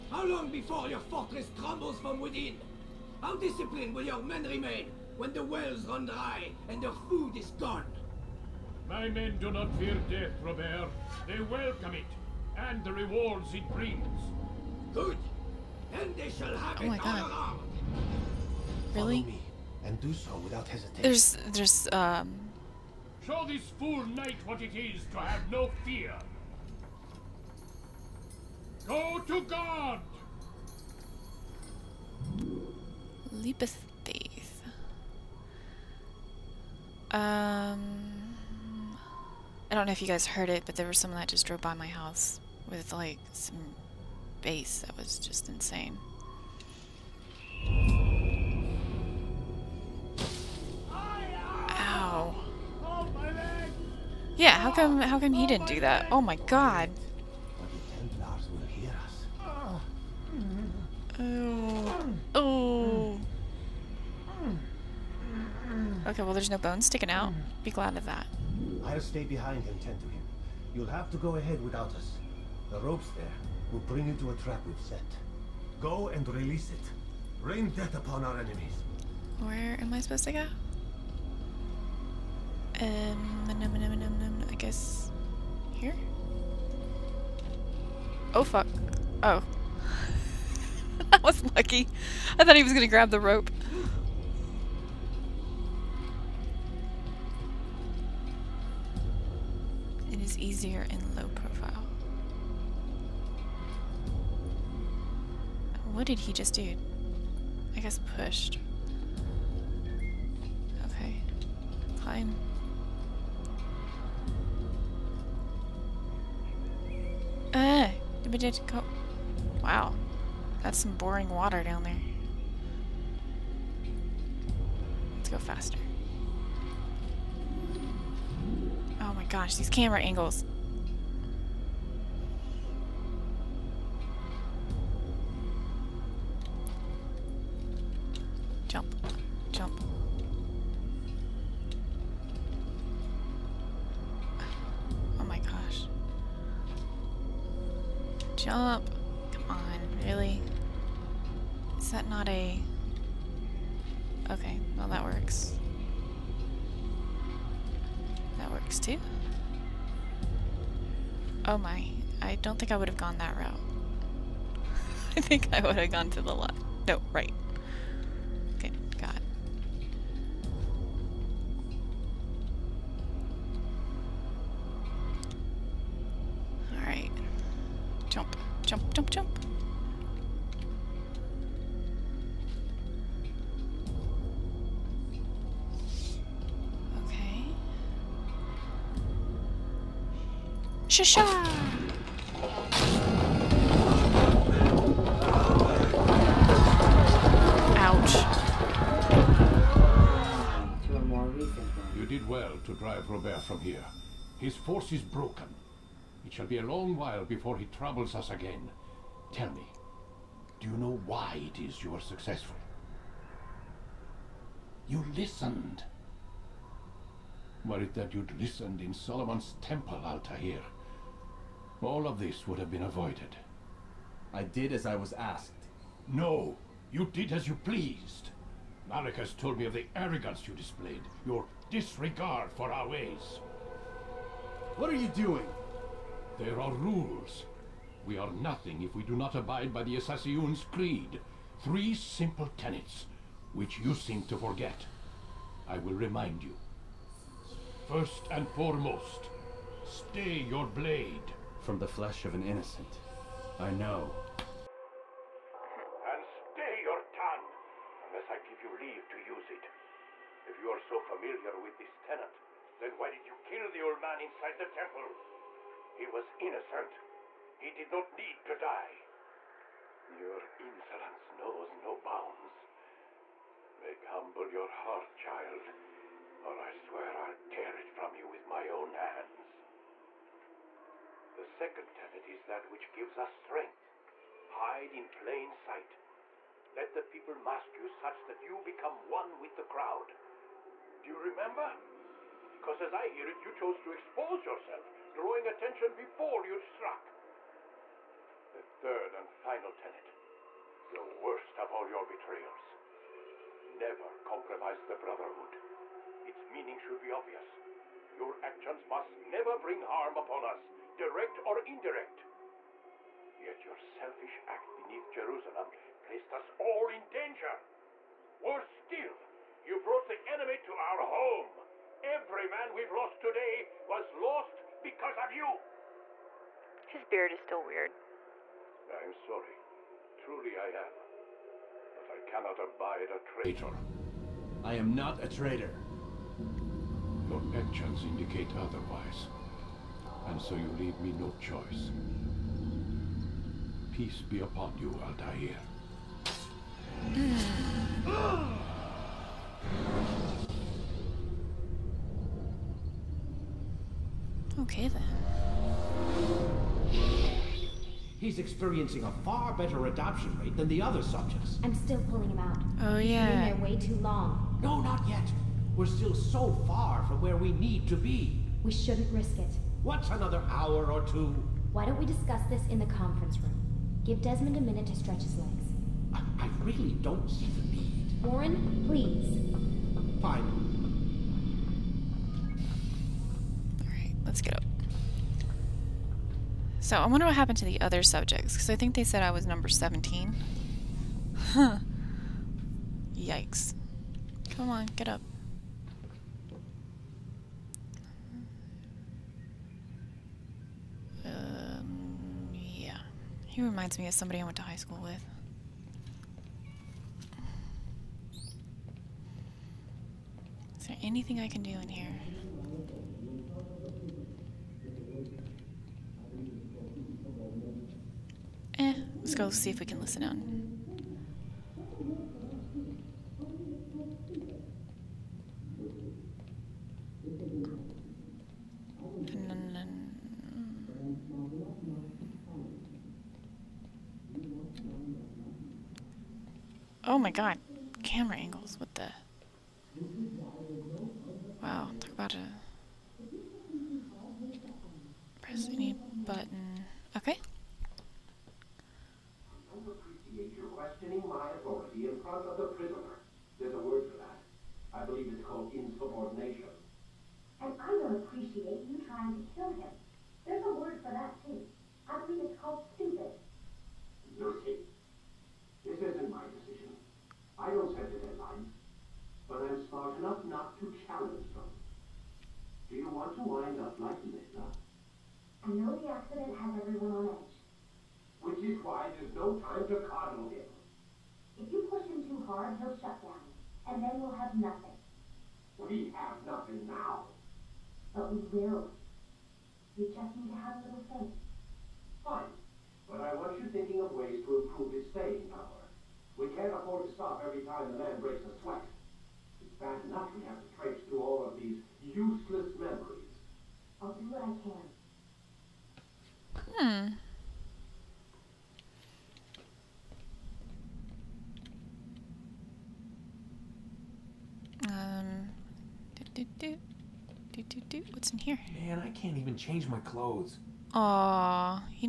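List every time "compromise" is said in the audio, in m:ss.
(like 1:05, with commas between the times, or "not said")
5:04.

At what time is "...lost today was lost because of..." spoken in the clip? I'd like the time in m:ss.
5:22.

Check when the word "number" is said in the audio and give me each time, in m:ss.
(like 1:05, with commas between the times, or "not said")
6:29.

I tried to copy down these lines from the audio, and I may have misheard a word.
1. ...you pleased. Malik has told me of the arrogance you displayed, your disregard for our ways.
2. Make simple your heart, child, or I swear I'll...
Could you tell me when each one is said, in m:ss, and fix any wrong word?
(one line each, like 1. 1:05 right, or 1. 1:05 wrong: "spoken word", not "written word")
1. 3:47 right
2. 4:33 wrong: "humble", not "simple".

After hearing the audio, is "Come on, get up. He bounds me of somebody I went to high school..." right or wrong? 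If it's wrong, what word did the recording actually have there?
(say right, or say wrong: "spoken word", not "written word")
wrong: "reminds", not "bounds".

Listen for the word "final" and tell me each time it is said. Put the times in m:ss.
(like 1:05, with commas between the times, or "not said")
4:59.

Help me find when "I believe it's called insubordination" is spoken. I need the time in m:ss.
7:34.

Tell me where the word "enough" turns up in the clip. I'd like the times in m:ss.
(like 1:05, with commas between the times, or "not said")
8:20.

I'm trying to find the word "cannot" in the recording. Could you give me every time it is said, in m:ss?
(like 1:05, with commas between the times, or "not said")
5:32.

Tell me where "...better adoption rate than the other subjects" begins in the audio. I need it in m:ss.
5:59.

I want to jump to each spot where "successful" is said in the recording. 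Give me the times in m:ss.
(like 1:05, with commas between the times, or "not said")
3:32.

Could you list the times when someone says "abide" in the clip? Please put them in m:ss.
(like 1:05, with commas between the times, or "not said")
3:59, 5:32.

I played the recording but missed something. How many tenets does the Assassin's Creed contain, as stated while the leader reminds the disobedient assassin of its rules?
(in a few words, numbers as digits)
3.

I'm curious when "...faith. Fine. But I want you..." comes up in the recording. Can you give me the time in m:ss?
8:11.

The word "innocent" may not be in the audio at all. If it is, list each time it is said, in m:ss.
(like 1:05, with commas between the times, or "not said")
4:12, 4:26.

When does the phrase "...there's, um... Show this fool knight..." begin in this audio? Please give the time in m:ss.
0:21.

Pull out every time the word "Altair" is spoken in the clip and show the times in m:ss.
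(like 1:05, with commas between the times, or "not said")
3:40, 5:45.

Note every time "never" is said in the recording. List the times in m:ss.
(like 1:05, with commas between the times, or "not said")
5:03, 5:09.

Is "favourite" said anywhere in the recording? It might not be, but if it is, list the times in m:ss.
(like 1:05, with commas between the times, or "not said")
not said.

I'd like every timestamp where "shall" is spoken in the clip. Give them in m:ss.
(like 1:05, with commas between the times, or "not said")
0:16, 3:26.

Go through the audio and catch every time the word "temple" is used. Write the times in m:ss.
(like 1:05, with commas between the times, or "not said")
3:39, 4:24.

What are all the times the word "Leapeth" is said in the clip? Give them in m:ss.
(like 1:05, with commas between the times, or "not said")
0:33.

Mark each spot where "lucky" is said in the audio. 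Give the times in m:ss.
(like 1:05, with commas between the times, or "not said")
1:31.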